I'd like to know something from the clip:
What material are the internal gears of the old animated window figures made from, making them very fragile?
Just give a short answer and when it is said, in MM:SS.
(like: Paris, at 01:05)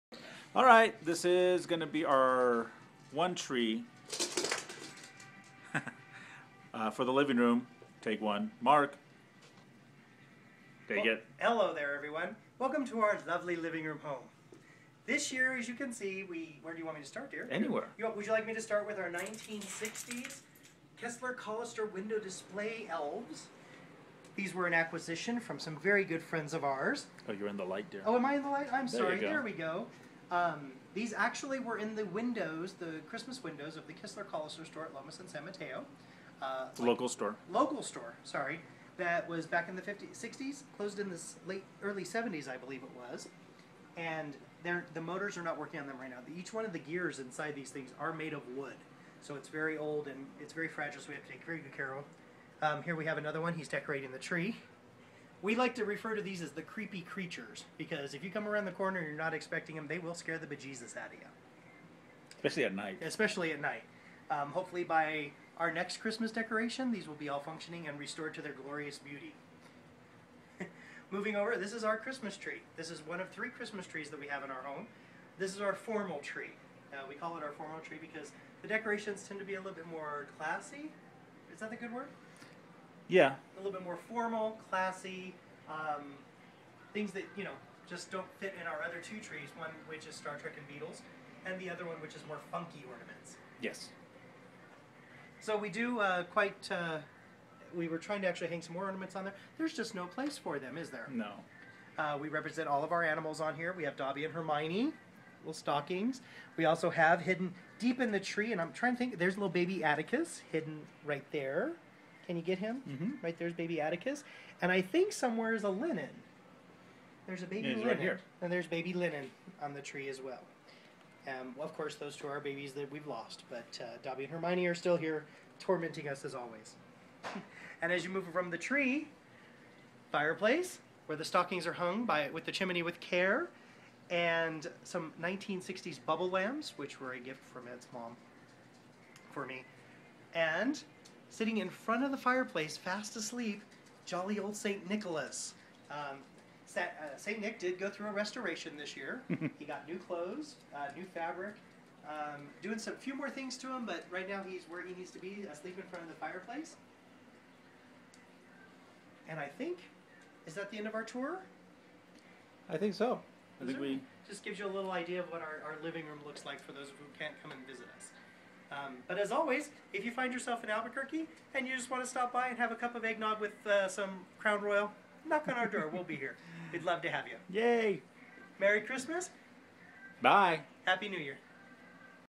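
Wood, at 00:48.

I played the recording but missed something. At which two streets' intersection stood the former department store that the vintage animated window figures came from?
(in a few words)
Lomas and San Mateo.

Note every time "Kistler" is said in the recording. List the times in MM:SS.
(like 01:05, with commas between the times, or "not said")
00:21, 00:33.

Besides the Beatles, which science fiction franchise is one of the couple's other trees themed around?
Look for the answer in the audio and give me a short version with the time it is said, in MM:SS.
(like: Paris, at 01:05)
Star Trek, at 01:30.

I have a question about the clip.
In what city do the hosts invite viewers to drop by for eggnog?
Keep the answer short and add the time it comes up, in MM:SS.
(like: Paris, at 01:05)
Albuquerque, at 02:50.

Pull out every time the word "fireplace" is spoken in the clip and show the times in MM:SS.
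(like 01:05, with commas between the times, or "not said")
02:10, 02:22, 02:36.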